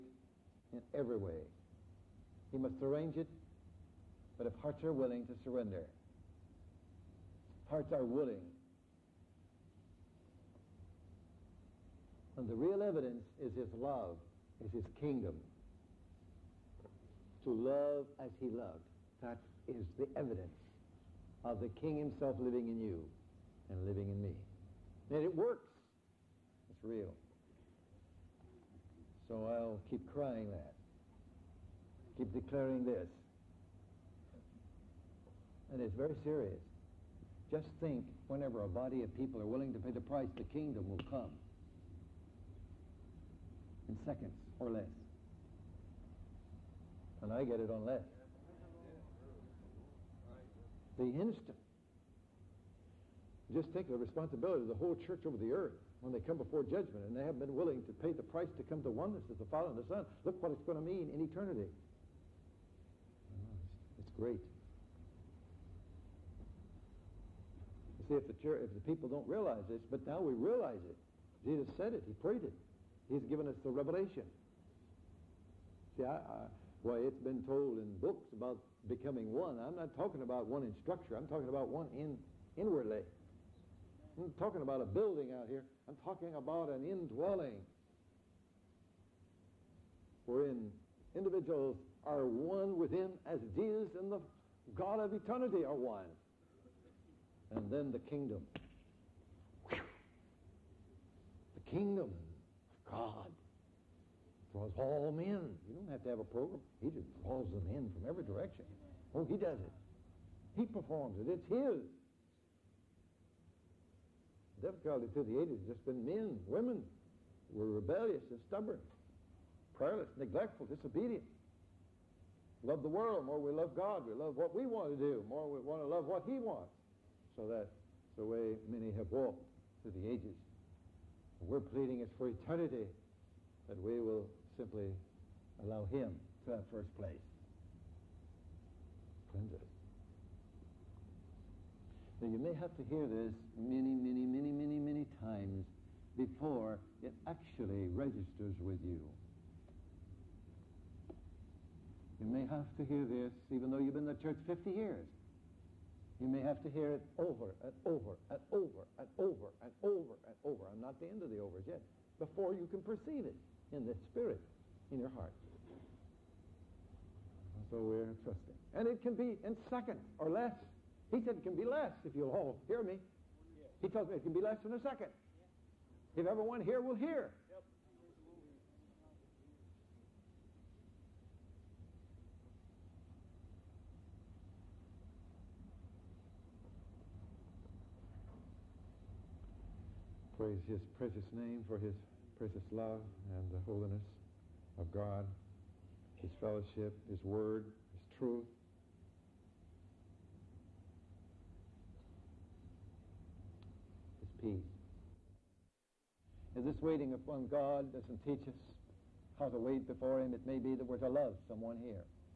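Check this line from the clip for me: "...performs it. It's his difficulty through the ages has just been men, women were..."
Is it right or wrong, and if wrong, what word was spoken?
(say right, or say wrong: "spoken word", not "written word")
right.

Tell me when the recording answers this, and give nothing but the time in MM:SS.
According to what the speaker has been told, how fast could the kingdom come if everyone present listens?
02:54.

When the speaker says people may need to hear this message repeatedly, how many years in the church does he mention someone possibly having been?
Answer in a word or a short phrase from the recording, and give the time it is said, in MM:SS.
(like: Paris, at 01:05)
50, at 02:34.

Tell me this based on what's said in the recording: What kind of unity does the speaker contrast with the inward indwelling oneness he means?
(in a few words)
Structure.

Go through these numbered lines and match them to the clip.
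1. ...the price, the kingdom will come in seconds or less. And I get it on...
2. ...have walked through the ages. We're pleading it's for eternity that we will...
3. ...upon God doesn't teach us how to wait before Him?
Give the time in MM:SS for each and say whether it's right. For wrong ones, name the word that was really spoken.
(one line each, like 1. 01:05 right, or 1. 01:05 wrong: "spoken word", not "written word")
1. 00:39 right
2. 02:08 right
3. 03:27 right.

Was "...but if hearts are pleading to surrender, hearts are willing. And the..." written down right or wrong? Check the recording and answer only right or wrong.
wrong.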